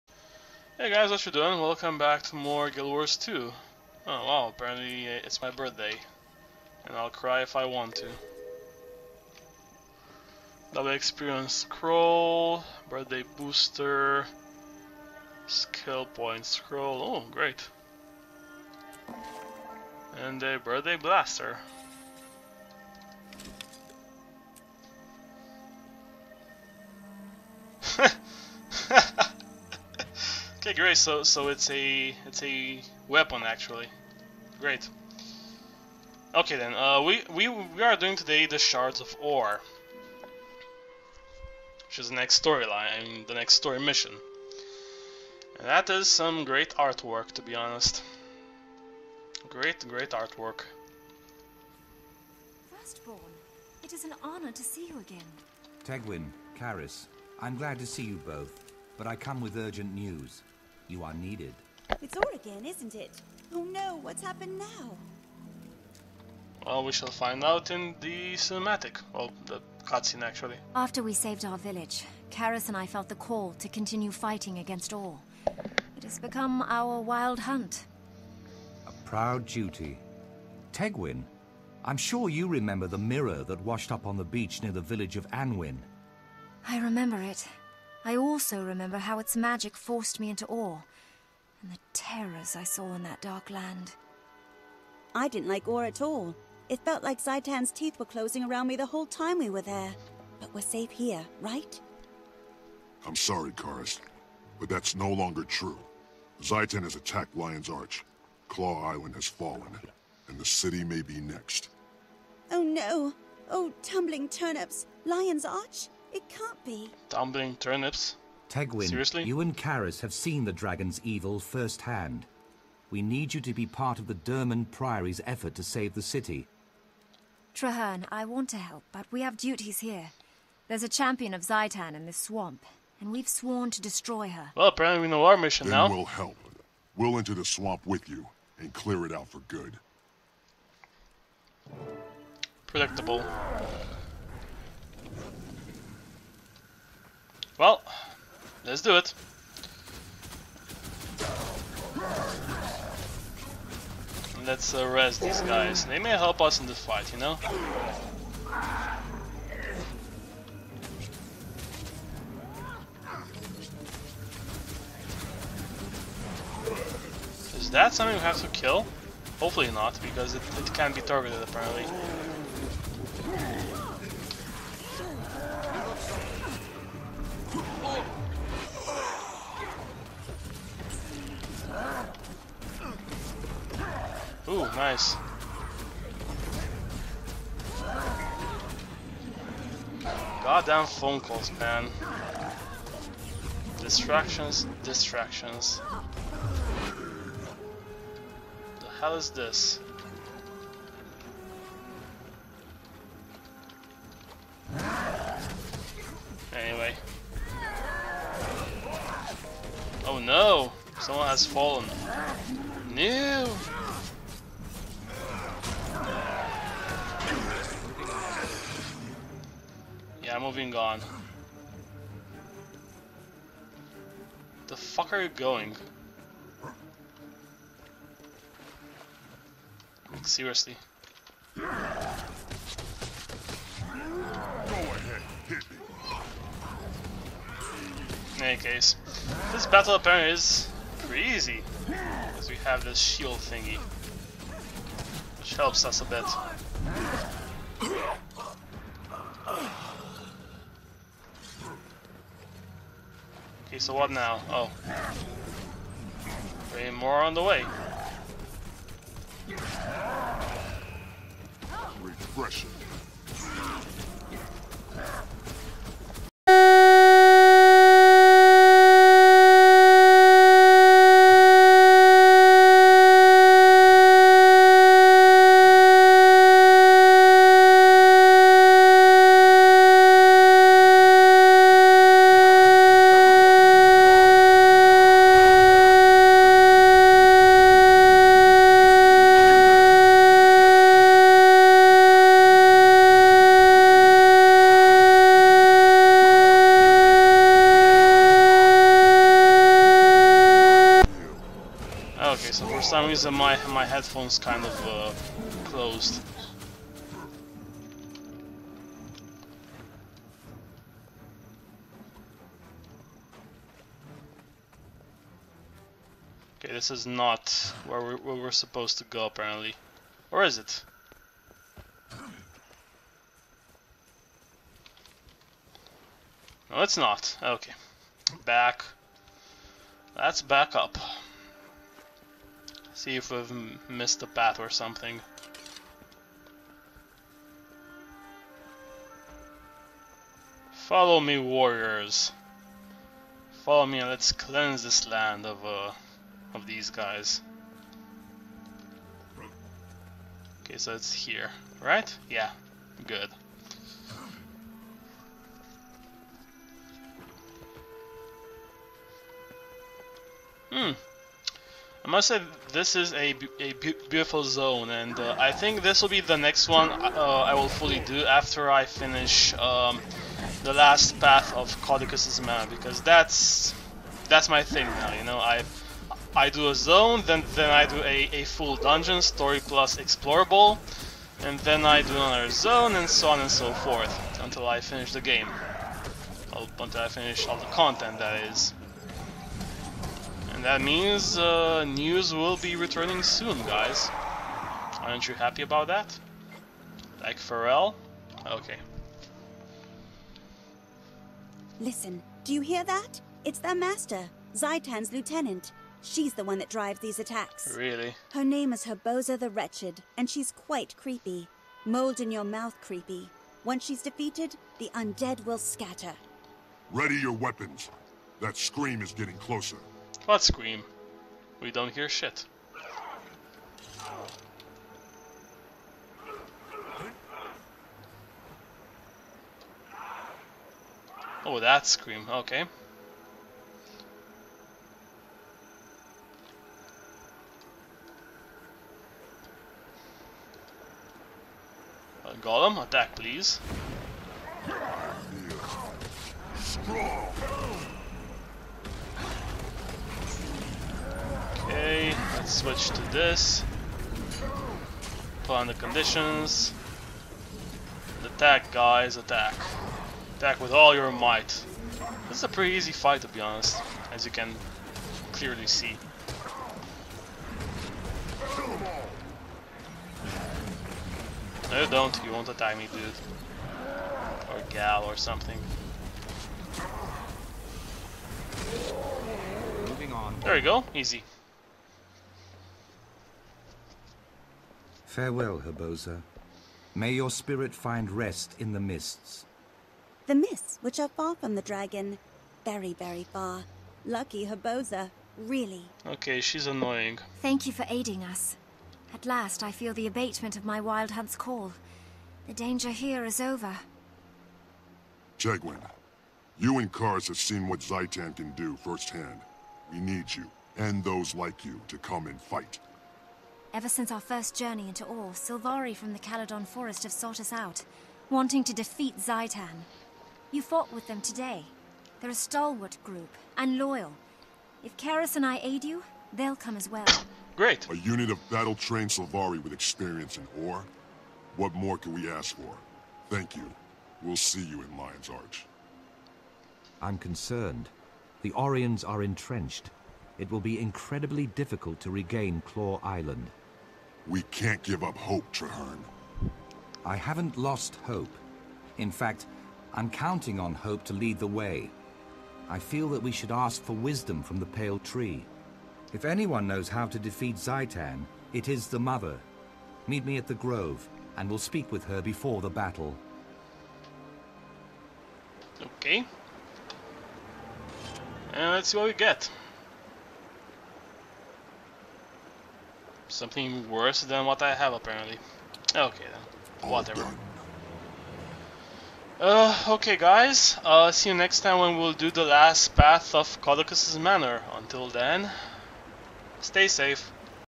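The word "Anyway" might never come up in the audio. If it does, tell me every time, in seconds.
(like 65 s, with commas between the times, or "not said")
206 s.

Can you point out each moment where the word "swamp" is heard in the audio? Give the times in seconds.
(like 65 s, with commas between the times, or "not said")
132 s, 137 s.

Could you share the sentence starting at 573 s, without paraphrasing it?
Something worse than what I have, apparently.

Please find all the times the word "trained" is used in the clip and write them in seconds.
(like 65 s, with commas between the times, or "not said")
528 s.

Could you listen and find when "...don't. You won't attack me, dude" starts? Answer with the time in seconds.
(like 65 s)
471 s.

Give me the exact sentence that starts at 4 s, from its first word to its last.
Oh wow, apparently uh, it's my birthday.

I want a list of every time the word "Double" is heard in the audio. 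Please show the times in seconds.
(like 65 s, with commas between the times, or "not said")
10 s.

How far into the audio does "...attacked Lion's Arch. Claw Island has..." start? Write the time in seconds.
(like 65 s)
106 s.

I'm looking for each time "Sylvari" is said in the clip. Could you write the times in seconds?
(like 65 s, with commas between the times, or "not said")
515 s, 529 s.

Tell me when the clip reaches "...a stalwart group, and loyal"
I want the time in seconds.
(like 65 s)
522 s.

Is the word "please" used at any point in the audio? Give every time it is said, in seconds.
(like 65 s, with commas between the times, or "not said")
443 s.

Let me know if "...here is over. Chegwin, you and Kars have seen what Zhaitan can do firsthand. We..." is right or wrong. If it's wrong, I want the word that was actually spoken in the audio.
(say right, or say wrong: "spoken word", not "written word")
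right.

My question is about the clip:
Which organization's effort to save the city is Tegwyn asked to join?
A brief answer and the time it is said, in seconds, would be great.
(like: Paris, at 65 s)
Durmand Priory, at 124 s.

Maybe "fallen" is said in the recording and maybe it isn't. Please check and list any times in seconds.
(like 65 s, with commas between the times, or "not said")
109 s, 211 s.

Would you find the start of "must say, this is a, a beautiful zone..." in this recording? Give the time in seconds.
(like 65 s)
362 s.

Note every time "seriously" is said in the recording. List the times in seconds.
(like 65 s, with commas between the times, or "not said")
118 s, 230 s.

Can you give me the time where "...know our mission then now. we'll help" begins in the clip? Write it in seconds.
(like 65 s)
135 s.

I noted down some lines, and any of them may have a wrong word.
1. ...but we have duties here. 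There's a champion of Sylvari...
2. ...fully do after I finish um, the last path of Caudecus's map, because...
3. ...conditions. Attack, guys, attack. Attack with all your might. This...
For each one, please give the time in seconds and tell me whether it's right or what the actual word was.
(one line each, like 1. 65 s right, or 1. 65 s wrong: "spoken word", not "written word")
1. 128 s wrong: "Zhaitan", not "Sylvari"
2. 367 s right
3. 455 s right.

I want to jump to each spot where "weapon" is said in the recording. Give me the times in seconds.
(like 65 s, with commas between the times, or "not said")
33 s, 417 s.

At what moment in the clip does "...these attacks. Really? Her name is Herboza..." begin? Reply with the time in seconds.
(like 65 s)
406 s.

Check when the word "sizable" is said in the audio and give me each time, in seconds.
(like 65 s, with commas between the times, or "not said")
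not said.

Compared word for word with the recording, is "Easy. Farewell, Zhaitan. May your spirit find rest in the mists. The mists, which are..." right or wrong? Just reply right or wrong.
wrong.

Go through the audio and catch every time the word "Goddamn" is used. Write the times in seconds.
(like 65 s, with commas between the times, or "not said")
190 s.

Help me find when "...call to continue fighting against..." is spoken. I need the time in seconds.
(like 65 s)
73 s.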